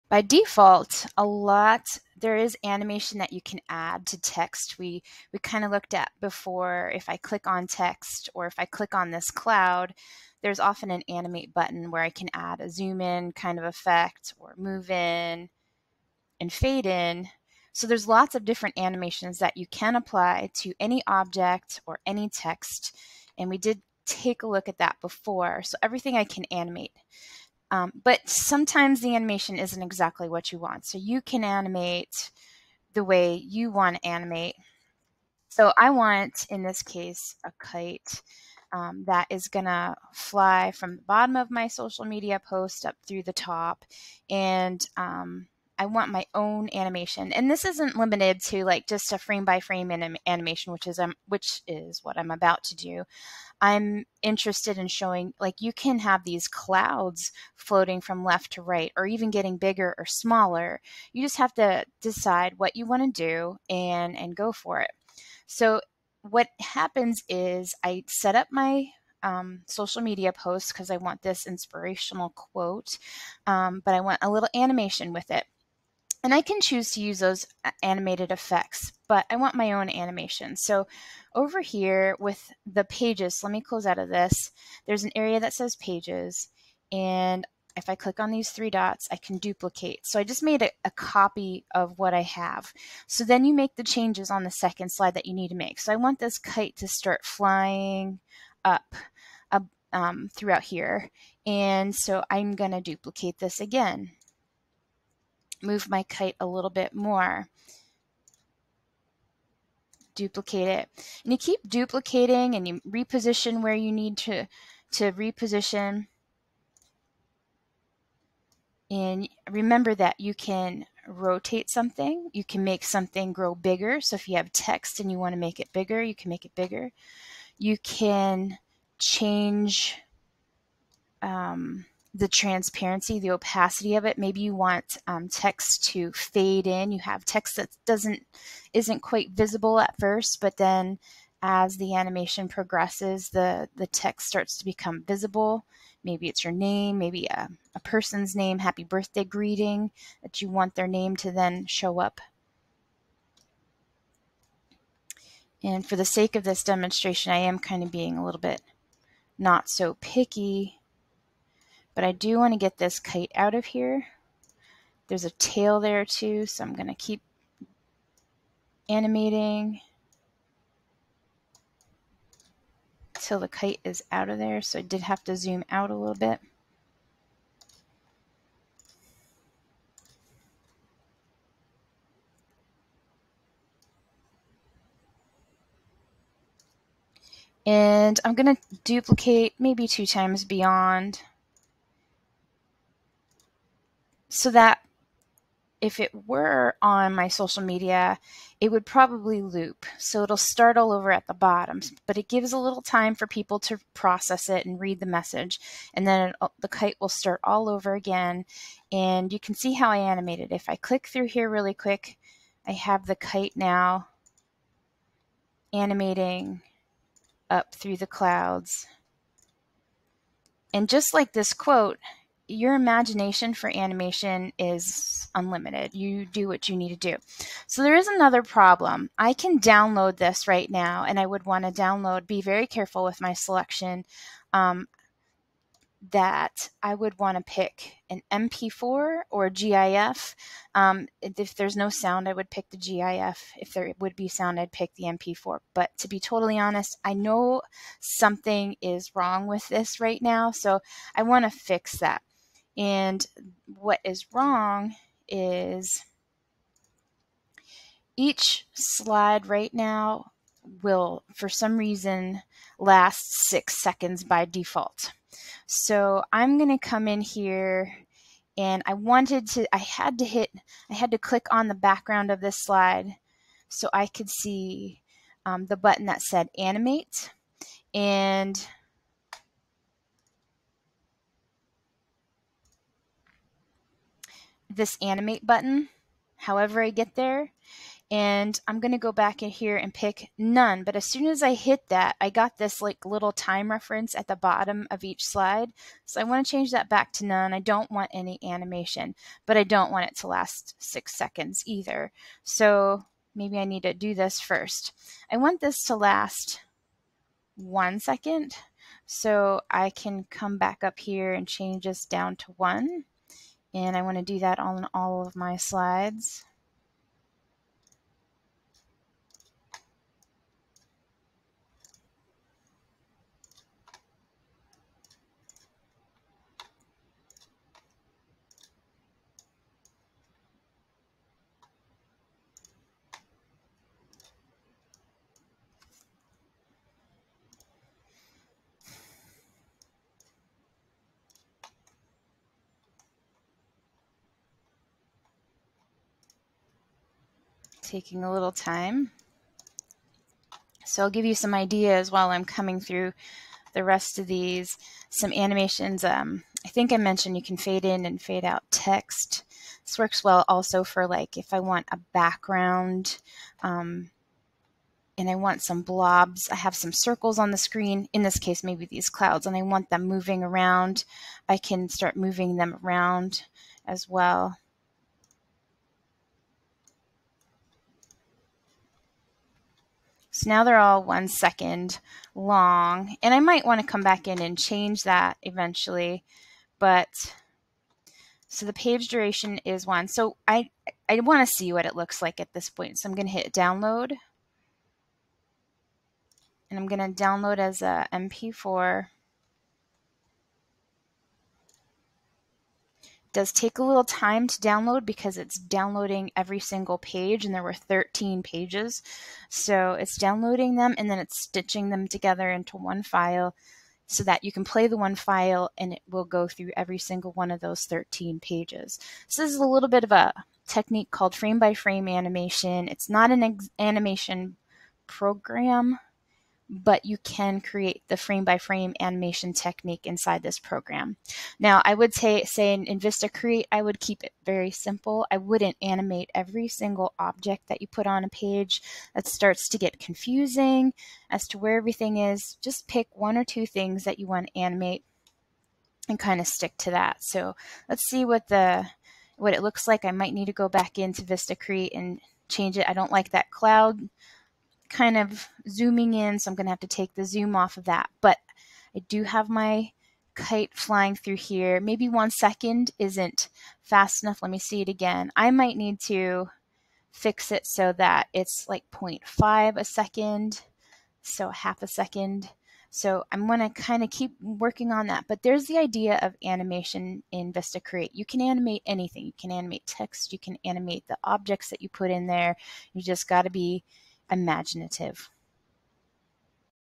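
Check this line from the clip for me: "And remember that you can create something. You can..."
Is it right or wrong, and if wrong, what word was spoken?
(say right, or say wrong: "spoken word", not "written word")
wrong: "rotate", not "create".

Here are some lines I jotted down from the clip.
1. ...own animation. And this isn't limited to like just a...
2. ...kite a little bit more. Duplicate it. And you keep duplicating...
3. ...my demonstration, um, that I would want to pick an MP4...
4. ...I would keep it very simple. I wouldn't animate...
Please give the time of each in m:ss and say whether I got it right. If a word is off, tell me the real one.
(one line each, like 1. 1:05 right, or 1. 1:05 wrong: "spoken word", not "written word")
1. 0:46 right
2. 1:46 right
3. 3:53 wrong: "selection", not "demonstration"
4. 7:13 right.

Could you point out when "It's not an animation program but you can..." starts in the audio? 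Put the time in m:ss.
7:02.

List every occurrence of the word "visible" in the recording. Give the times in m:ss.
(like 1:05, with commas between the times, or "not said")
2:19, 2:25.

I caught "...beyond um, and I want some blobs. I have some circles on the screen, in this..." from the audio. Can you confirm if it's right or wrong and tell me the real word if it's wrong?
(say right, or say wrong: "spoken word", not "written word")
wrong: "background", not "beyond".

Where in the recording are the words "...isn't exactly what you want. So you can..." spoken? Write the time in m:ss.
0:29.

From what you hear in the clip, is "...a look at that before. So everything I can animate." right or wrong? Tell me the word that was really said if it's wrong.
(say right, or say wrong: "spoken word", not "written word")
right.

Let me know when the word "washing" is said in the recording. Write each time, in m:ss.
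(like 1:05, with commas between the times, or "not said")
not said.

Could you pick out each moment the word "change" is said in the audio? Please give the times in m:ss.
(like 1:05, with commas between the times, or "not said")
1:33, 2:08, 4:56, 5:11, 6:24, 7:32.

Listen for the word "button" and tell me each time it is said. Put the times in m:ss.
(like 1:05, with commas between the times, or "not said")
0:11, 4:35, 4:45.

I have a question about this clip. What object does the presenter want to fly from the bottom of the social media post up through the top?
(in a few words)
A kite.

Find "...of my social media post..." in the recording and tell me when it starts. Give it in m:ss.
0:41.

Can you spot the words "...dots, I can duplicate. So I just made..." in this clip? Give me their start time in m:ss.
1:28.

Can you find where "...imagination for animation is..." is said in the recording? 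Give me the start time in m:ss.
3:42.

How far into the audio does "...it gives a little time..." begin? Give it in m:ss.
3:22.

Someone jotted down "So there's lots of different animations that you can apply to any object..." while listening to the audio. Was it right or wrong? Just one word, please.
right.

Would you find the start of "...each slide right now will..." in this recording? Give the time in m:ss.
4:18.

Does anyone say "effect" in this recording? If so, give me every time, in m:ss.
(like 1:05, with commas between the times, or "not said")
0:13, 1:18.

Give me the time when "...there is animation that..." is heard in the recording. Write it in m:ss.
0:02.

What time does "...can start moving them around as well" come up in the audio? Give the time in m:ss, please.
6:11.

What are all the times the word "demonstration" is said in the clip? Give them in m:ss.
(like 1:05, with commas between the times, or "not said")
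2:36.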